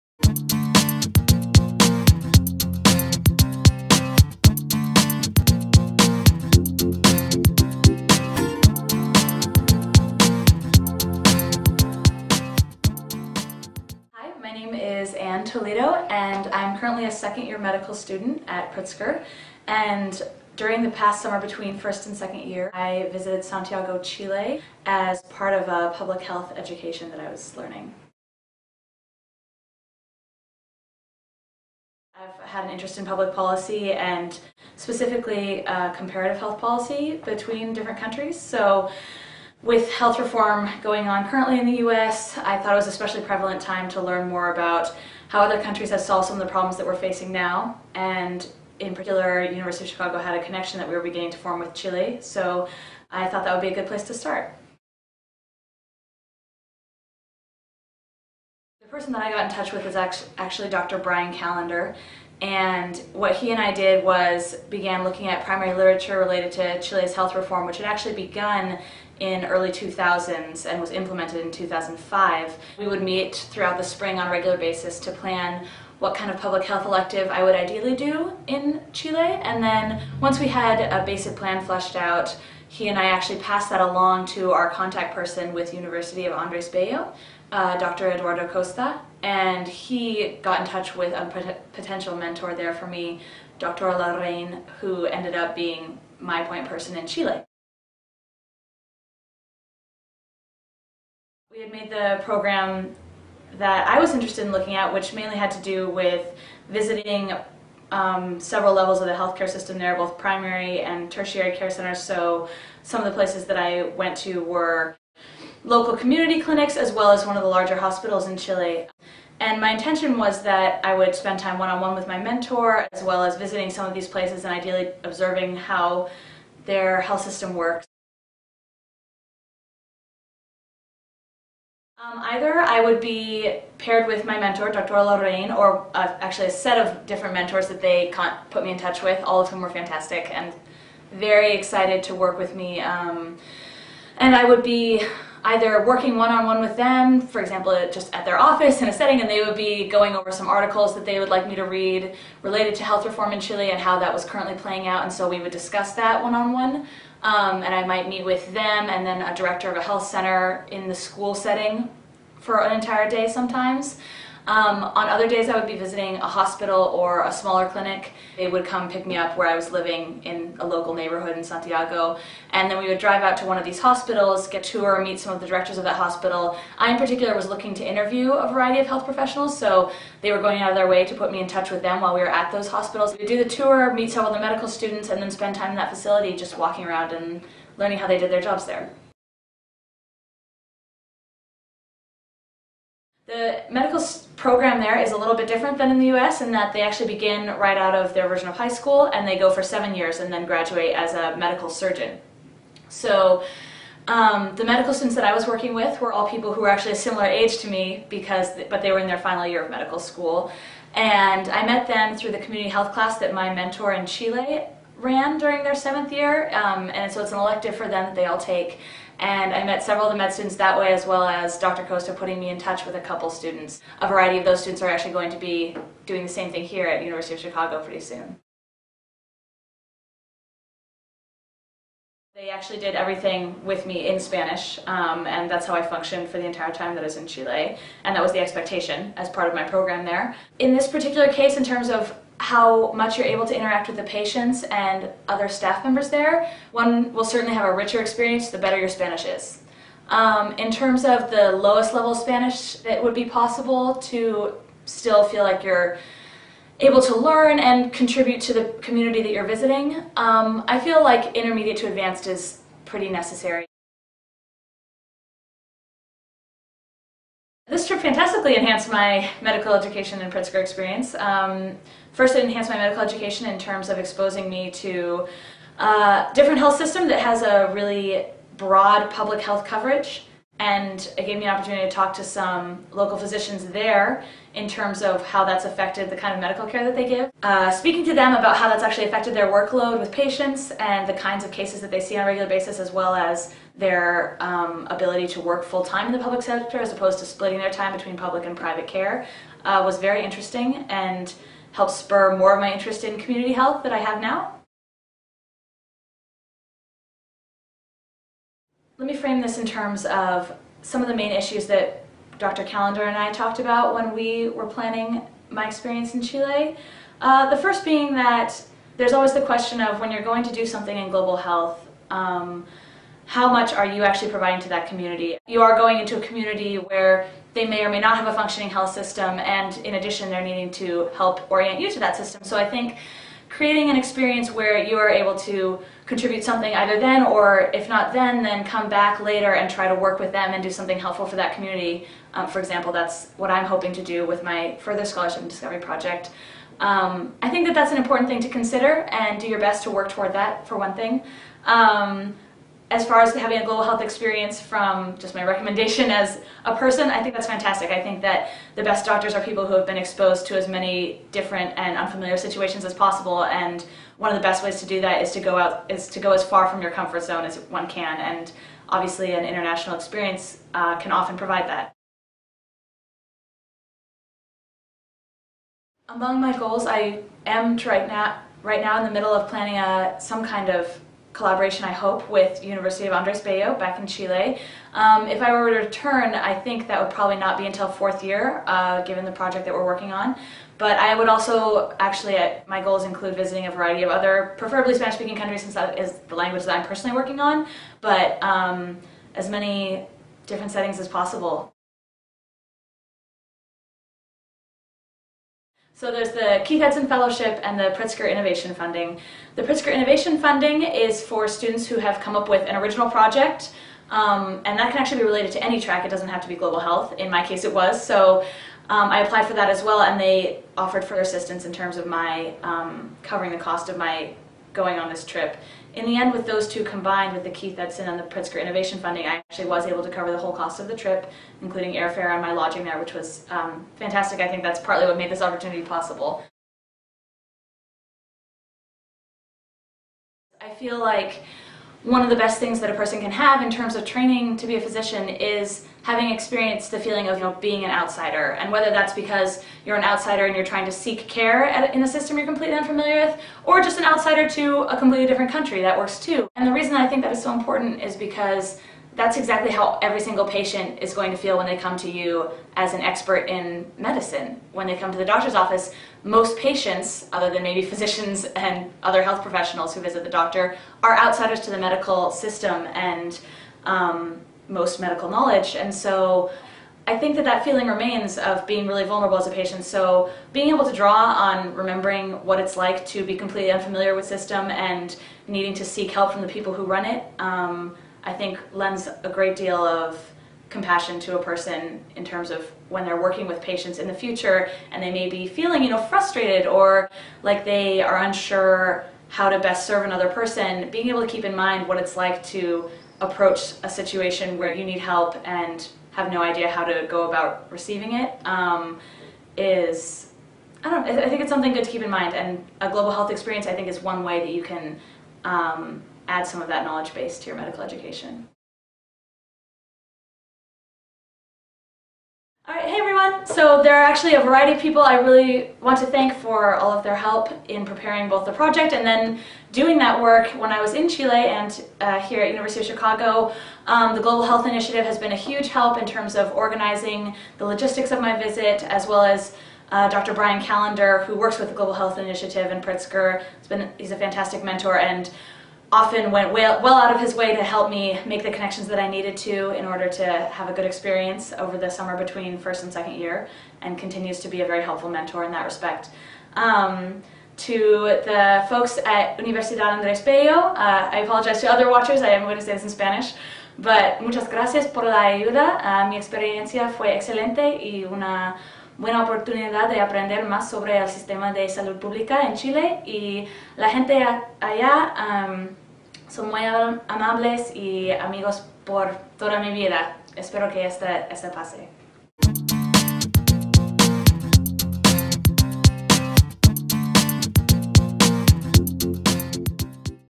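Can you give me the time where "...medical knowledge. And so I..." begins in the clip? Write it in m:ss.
7:55.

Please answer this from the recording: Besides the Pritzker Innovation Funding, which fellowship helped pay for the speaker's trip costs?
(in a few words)
Keith Edson Fellowship.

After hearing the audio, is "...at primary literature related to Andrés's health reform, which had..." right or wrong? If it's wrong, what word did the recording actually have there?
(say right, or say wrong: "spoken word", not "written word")
wrong: "Chile", not "Andrés".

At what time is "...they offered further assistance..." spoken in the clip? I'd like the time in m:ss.
7:00.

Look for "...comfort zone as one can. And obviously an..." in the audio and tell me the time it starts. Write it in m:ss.
6:06.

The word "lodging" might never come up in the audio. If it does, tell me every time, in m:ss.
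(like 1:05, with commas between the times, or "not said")
7:12.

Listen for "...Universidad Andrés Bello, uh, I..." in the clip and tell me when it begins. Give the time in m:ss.
9:19.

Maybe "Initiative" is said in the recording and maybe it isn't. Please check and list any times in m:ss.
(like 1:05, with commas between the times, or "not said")
8:54, 9:02.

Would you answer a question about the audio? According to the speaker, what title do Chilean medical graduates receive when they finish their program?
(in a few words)
Medical surgeon.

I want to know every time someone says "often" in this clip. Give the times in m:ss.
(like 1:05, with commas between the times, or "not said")
6:11, 9:05.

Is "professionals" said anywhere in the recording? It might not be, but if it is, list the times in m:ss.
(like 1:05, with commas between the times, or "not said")
2:59, 7:49.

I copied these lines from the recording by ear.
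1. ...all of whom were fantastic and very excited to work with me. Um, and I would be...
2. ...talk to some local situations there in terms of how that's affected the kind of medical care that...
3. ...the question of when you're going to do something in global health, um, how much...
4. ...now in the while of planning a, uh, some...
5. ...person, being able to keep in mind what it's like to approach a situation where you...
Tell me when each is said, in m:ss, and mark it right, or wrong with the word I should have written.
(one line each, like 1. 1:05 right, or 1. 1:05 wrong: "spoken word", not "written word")
1. 2:19 right
2. 4:41 wrong: "physicians", not "situations"
3. 5:19 right
4. 6:18 wrong: "middle", not "while"
5. 8:20 right.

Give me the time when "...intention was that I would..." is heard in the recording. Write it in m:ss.
1:59.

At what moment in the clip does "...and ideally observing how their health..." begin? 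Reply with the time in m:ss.
2:04.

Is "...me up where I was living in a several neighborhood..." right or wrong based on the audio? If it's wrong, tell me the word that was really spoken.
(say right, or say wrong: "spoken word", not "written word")
wrong: "local", not "several".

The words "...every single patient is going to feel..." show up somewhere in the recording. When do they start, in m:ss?
7:40.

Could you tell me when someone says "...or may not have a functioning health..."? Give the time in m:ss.
5:27.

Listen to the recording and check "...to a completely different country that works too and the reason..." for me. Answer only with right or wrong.
right.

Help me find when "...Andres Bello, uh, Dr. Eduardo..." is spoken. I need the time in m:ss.
1:26.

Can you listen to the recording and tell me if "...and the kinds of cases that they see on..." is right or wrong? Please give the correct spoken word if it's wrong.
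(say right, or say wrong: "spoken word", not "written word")
right.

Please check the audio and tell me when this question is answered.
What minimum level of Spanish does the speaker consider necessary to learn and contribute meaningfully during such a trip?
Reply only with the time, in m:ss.
4:21.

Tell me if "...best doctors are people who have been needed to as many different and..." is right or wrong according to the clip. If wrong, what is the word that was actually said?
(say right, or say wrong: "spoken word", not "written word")
wrong: "exposed", not "needed".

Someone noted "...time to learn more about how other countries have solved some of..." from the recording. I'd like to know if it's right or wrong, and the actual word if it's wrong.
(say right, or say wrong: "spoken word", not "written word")
right.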